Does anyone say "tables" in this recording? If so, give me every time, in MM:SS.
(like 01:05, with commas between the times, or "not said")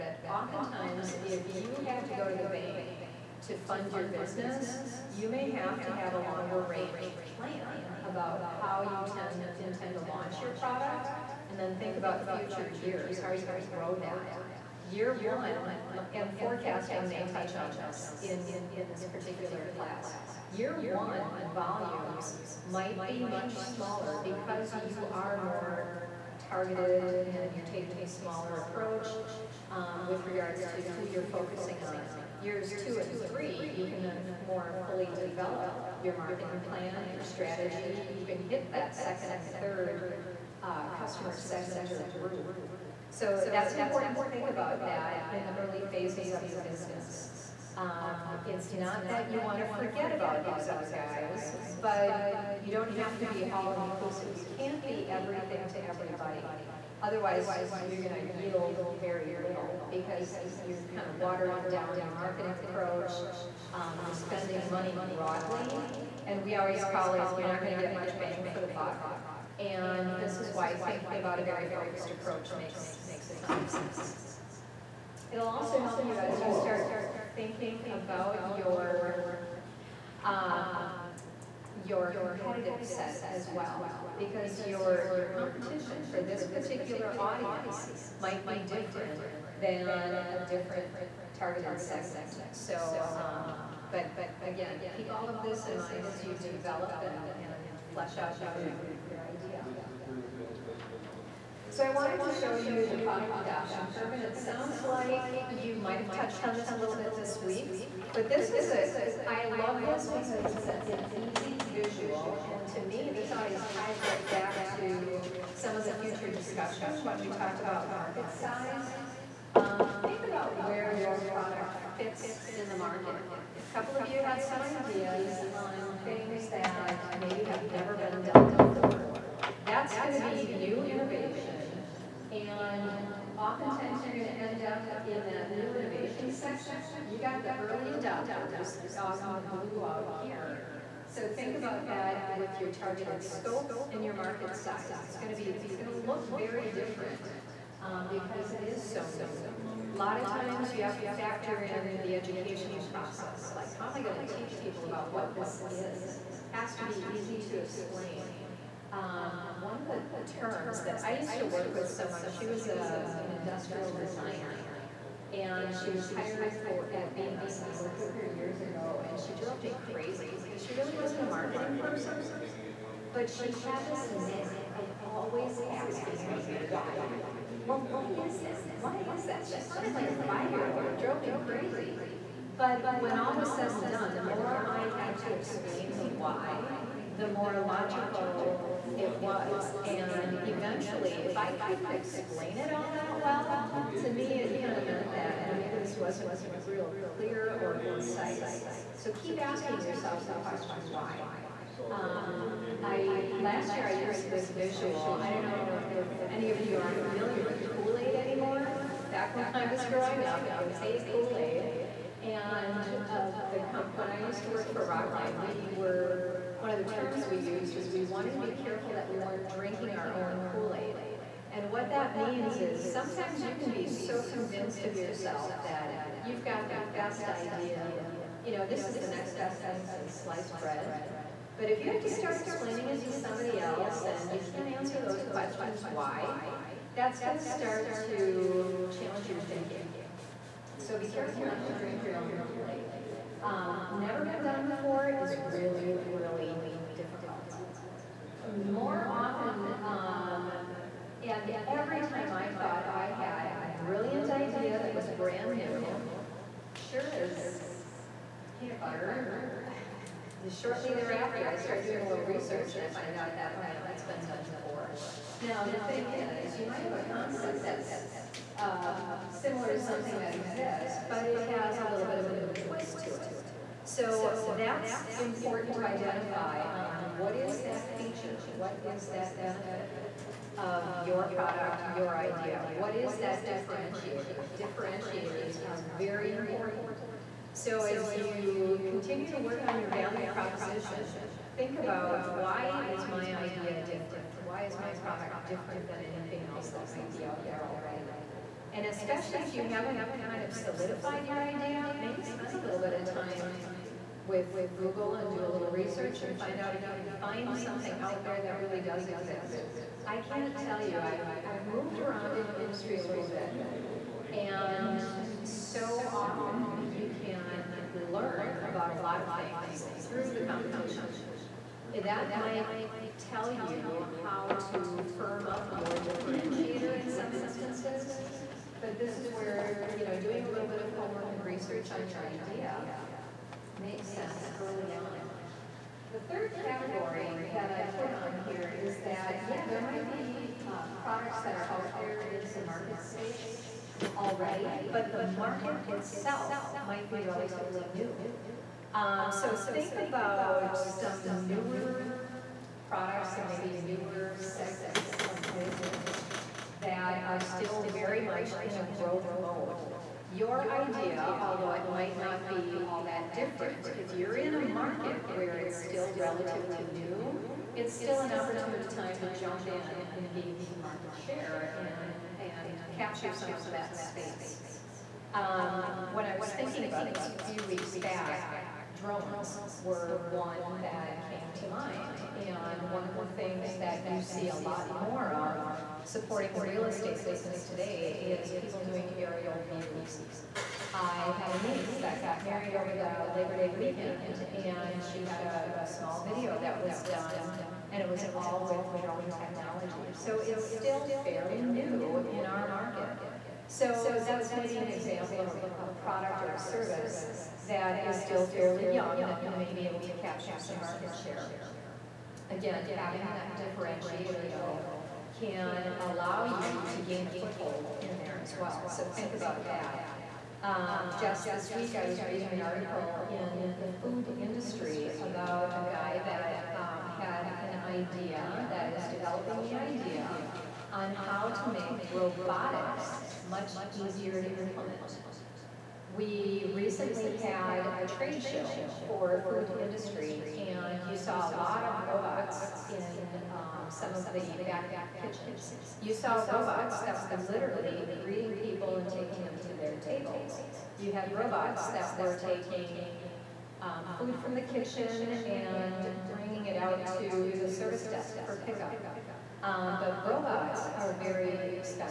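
07:29.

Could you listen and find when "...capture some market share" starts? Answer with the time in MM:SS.
06:50.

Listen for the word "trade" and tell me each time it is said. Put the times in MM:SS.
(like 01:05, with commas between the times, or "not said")
07:18.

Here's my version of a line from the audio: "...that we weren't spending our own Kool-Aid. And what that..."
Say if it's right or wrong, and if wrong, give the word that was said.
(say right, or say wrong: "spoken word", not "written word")
wrong: "drinking", not "spending".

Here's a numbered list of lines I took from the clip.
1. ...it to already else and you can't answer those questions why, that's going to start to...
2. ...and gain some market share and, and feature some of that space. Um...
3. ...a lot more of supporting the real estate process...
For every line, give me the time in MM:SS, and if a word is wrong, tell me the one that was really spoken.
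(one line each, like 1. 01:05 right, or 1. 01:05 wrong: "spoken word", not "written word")
1. 03:52 wrong: "somebody", not "already"
2. 06:10 wrong: "capture", not "feature"
3. 06:24 wrong: "business", not "process".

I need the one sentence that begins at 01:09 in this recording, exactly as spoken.
And this is why thinking about a very focused approach makes makes a ton of sense.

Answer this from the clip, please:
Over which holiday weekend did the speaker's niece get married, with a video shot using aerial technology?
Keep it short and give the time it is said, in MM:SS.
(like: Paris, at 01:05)
Labor Day, at 06:33.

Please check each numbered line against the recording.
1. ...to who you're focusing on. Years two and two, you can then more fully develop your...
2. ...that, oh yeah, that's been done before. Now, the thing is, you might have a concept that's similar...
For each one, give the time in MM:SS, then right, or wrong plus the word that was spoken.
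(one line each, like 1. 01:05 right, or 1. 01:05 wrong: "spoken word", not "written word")
1. 00:30 wrong: "three", not "two"
2. 04:23 right.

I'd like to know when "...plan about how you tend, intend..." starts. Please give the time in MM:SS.
00:07.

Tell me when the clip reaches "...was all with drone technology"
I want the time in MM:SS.
06:38.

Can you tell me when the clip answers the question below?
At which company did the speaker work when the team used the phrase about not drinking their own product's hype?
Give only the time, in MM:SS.
03:34.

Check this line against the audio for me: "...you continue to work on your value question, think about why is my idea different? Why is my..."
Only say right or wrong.
wrong.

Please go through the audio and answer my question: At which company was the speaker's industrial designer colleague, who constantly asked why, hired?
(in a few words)
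Bemis.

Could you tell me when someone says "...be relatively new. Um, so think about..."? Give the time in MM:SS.
05:47.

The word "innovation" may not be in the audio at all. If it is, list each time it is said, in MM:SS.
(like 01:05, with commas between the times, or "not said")
02:10, 02:15.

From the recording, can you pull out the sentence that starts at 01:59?
Um, think about where your product fits in the market.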